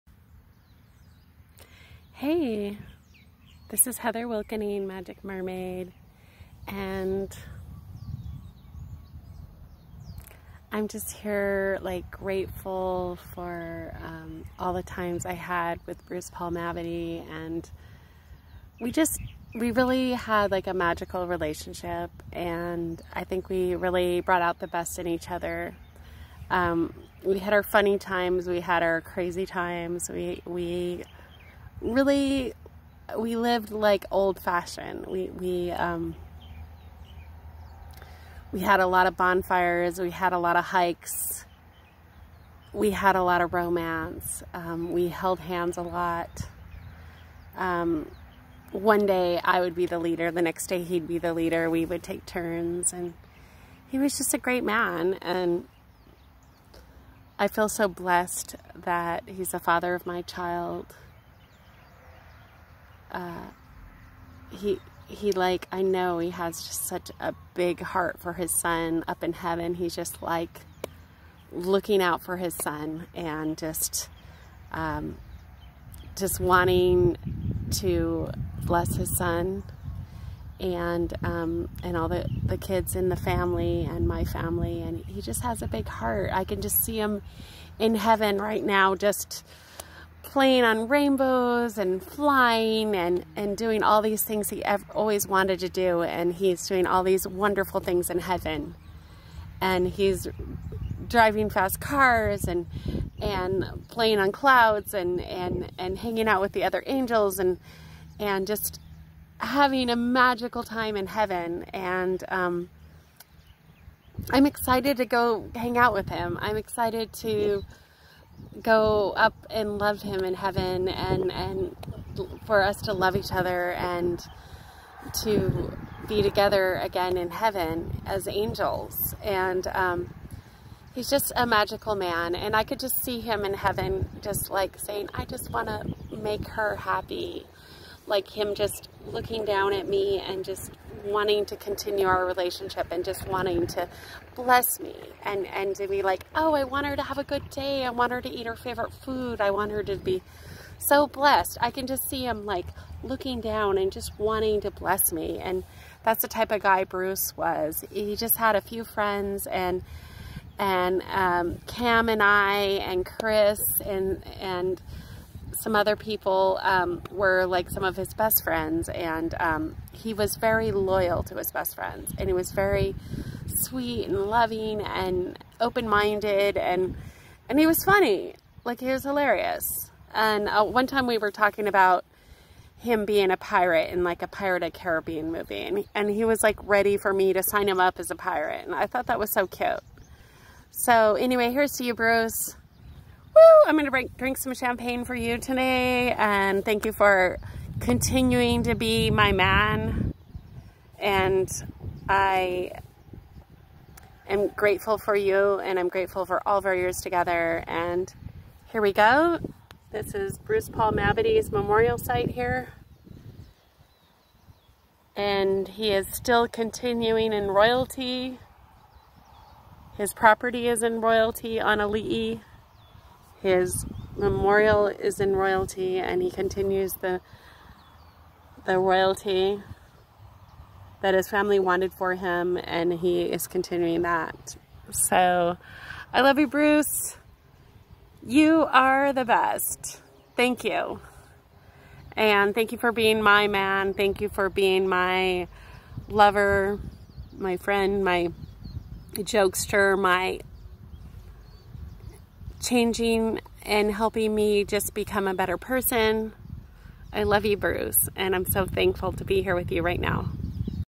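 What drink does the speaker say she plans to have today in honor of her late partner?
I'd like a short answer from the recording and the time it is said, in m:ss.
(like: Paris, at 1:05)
Champagne, at 3:14.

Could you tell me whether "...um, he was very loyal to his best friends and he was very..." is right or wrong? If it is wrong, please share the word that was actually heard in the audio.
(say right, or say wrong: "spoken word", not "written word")
right.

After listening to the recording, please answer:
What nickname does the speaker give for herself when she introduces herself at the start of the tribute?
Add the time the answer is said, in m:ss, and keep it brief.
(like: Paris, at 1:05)
Magic Mermaid, at 0:04.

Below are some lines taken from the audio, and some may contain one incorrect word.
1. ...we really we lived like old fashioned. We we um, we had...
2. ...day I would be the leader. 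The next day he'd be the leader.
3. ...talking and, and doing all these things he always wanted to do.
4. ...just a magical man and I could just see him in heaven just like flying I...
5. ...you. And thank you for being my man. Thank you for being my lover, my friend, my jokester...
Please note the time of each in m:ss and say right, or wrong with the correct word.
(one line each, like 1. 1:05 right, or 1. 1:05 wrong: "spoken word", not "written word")
1. 0:30 right
2. 0:49 right
3. 1:32 wrong: "flying", not "talking"
4. 2:11 wrong: "saying", not "flying"
5. 4:00 right.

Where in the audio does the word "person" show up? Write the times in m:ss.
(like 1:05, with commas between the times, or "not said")
4:15.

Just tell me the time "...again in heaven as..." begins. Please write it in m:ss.
2:06.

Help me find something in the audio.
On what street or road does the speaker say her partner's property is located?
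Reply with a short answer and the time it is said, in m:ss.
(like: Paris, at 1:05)
Ali'i, at 3:41.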